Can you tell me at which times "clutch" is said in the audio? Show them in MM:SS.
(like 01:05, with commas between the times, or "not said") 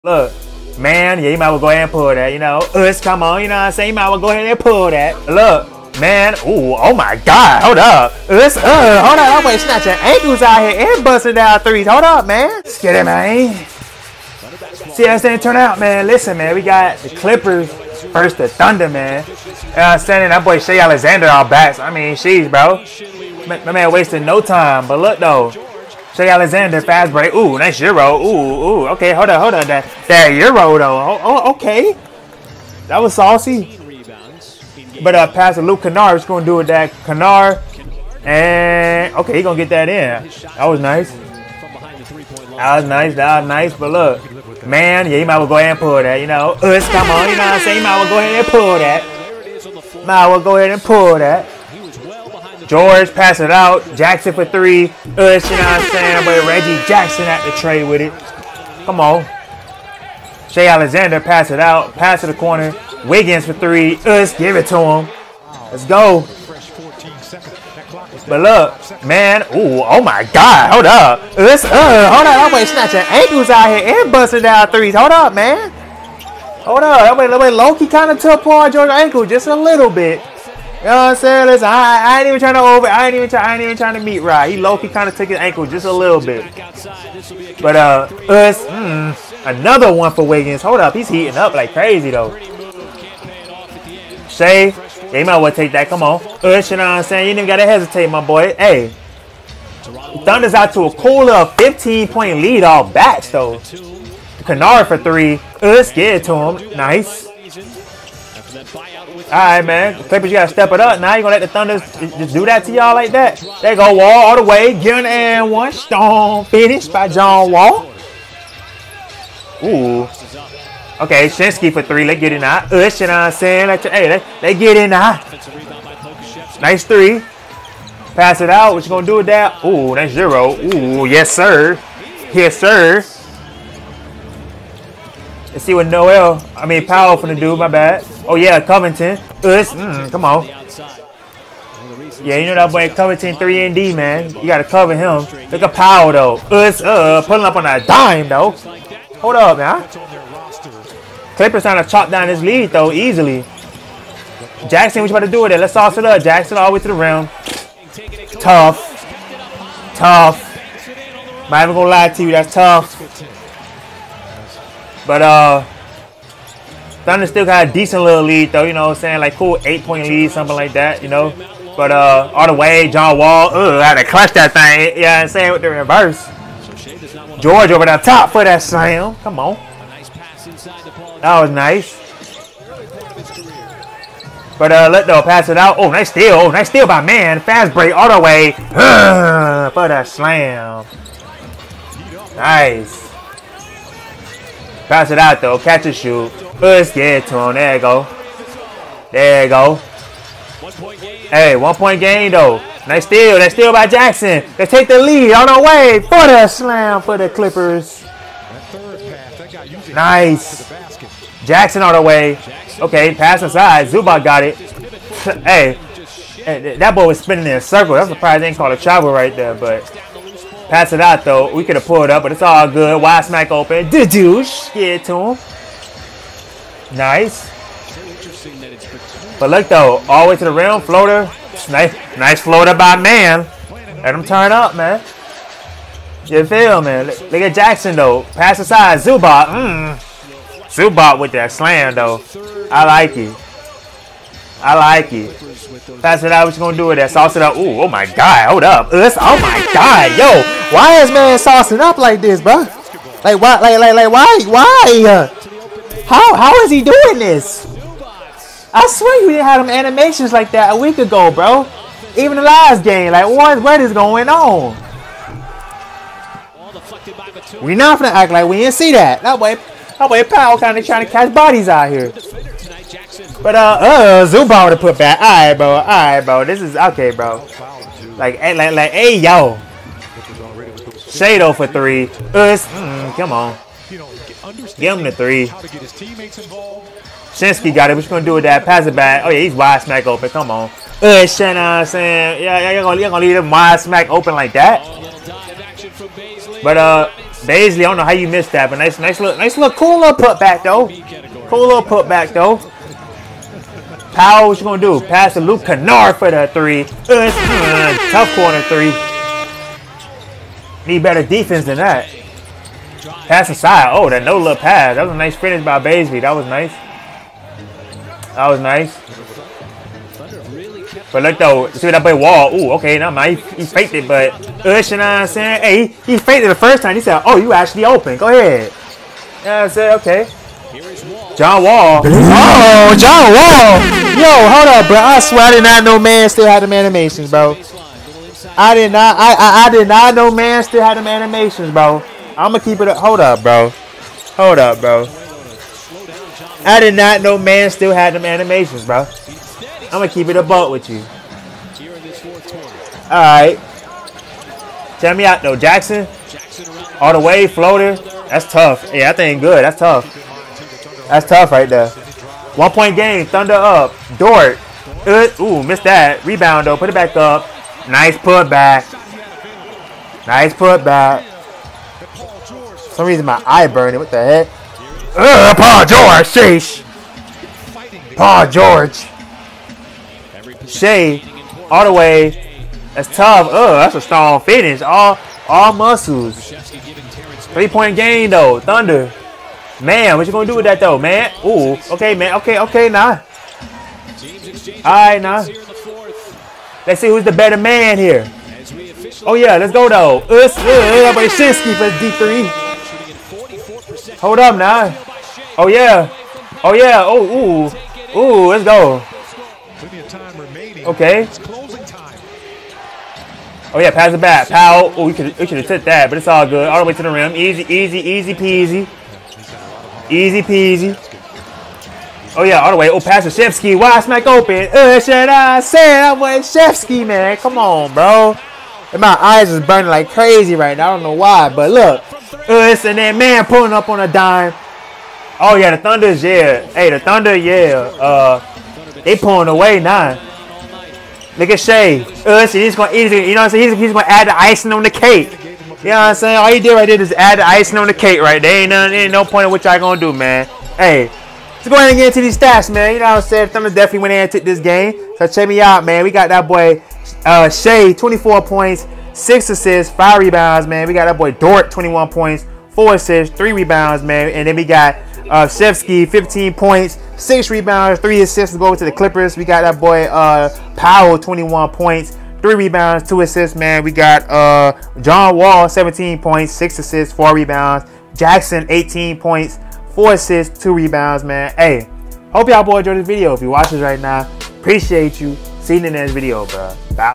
02:54.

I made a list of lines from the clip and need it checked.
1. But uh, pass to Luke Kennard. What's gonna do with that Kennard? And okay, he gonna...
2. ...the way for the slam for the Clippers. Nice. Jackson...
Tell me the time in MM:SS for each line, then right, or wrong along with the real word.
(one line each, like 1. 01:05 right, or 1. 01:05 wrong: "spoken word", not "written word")
1. 00:35 right
2. 03:25 right.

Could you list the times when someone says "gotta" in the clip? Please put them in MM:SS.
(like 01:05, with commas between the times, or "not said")
01:37, 01:50, 02:24.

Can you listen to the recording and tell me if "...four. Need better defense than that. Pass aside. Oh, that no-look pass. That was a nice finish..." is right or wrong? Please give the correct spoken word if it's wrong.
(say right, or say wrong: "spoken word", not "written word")
wrong: "three", not "four".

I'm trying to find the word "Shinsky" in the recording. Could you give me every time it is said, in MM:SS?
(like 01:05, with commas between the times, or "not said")
02:01, 04:47, 06:41.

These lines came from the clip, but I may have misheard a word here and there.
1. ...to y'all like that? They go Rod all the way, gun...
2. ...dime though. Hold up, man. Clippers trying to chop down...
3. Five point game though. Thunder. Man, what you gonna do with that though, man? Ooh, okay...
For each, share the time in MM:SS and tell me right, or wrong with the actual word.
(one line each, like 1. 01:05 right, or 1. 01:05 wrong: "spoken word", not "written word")
1. 01:52 wrong: "Wall", not "Rod"
2. 02:27 right
3. 06:27 wrong: "Three", not "Five".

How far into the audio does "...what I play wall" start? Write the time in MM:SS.
05:21.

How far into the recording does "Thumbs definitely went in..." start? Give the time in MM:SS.
07:33.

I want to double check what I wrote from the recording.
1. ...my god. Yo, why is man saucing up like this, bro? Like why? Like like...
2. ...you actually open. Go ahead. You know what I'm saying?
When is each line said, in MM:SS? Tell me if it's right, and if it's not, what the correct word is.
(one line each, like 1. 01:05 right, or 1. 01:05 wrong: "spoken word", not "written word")
1. 04:09 right
2. 05:27 right.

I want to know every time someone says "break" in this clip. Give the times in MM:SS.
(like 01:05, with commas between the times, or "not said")
00:27, 03:07.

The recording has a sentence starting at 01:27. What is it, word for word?
But uh, us mm, another one for Wiggins.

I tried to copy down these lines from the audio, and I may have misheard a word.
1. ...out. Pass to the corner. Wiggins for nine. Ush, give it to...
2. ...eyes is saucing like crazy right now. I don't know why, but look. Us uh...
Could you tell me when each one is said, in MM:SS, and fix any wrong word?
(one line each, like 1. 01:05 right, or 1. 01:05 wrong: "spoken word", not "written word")
1. 01:01 wrong: "three", not "nine"
2. 07:09 wrong: "burning", not "saucing".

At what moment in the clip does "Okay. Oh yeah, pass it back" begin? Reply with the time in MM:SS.
06:50.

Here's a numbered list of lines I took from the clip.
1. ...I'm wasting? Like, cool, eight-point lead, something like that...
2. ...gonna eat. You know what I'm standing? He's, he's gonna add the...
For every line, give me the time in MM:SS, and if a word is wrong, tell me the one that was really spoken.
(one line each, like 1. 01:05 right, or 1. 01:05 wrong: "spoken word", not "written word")
1. 02:48 wrong: "saying", not "wasting"
2. 07:22 wrong: "saying", not "standing".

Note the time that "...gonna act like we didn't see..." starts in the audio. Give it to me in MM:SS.
04:27.